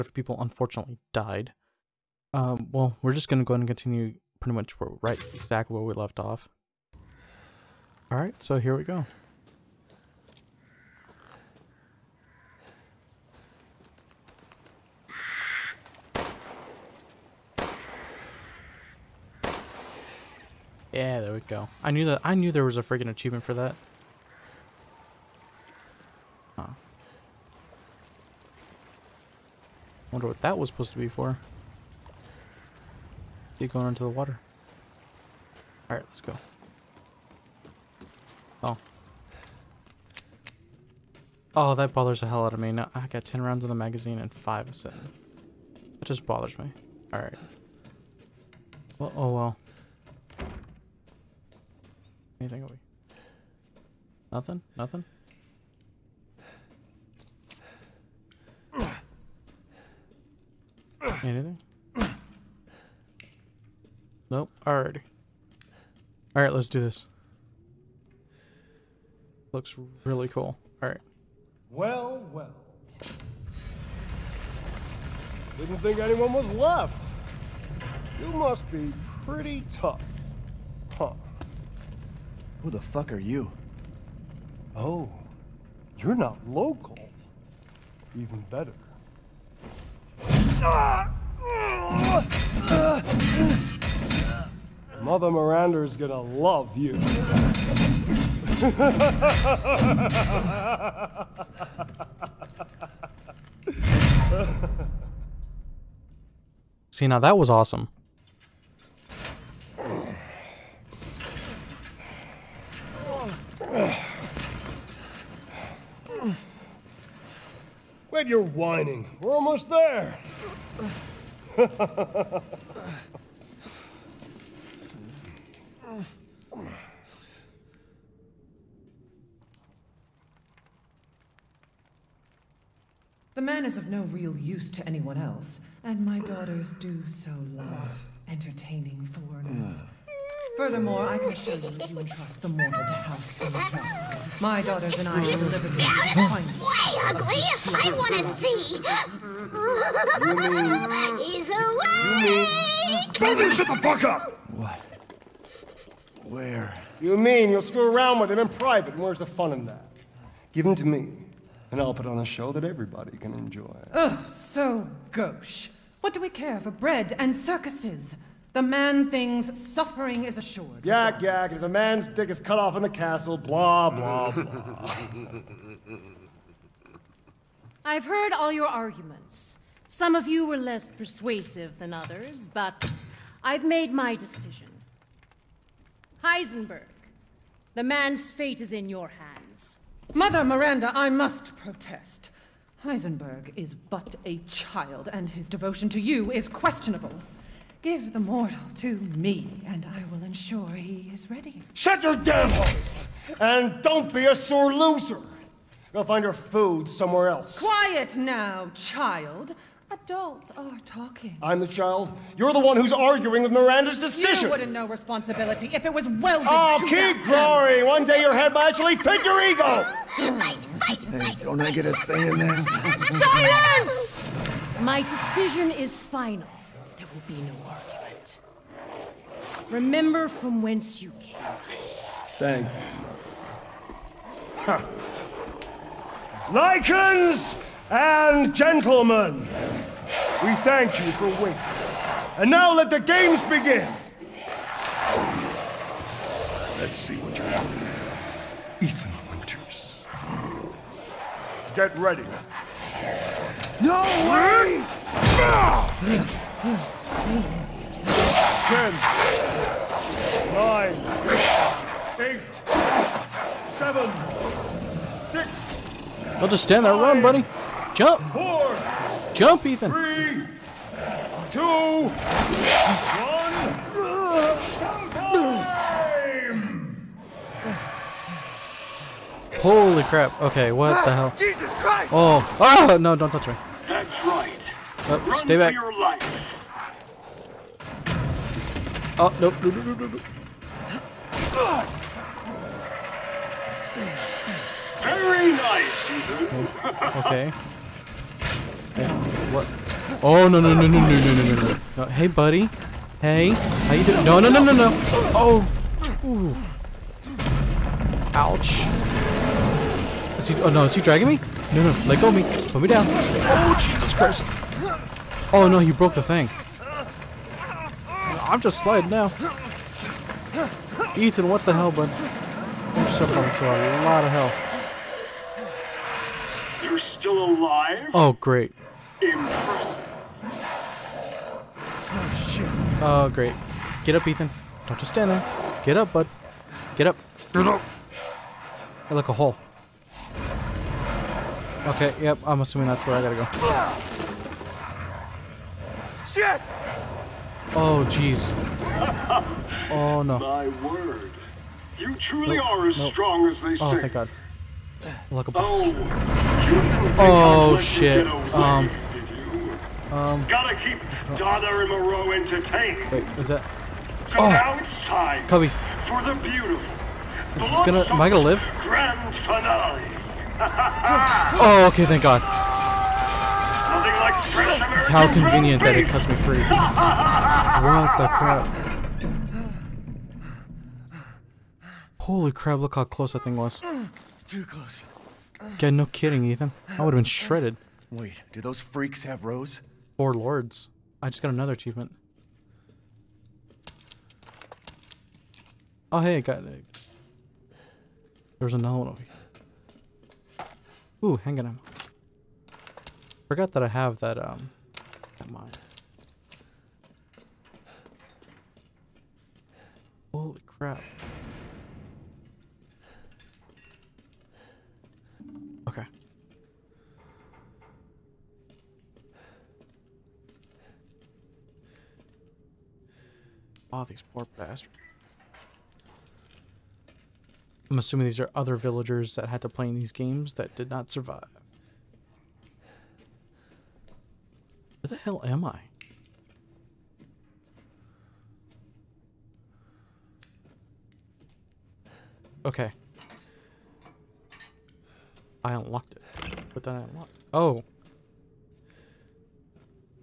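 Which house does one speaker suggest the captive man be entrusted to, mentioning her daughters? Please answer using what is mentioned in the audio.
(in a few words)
House Dimitrescu.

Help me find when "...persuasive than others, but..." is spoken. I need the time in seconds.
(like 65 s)
180 s.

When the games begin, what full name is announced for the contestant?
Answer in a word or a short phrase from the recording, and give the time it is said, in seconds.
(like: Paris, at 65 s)
Ethan Winters, at 248 s.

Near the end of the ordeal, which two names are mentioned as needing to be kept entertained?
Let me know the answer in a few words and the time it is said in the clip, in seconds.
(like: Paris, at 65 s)
Donna and Moreau, at 361 s.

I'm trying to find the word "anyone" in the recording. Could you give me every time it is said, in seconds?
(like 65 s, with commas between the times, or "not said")
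75 s, 134 s.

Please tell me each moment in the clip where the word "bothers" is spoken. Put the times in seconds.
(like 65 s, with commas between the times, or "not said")
41 s, 46 s.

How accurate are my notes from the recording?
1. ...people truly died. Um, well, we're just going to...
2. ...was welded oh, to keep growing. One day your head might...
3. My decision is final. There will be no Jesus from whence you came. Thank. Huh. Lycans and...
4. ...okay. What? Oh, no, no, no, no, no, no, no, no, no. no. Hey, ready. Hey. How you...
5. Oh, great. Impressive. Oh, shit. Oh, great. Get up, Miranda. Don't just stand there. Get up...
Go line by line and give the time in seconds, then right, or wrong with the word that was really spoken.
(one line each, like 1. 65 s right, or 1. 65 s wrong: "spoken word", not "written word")
1. 0 s wrong: "unfortunately", not "truly"
2. 215 s right
3. 224 s wrong: "Remember", not "Jesus"
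4. 297 s wrong: "buddy", not "ready"
5. 328 s wrong: "Ethan", not "Miranda".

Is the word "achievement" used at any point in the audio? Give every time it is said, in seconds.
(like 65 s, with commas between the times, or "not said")
23 s, 391 s.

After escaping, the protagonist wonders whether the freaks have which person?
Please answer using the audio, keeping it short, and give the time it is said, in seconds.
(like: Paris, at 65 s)
Rose, at 389 s.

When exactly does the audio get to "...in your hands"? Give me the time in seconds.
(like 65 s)
188 s.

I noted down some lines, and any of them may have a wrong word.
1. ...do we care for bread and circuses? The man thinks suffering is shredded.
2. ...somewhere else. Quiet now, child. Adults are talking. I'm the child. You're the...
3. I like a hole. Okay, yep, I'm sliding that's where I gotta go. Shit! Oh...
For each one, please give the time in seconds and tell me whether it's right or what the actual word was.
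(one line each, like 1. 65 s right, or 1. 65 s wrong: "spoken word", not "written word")
1. 166 s wrong: "assured", not "shredded"
2. 206 s right
3. 339 s wrong: "assuming", not "sliding".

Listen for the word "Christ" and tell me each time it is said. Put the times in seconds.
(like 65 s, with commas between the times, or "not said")
281 s, 314 s.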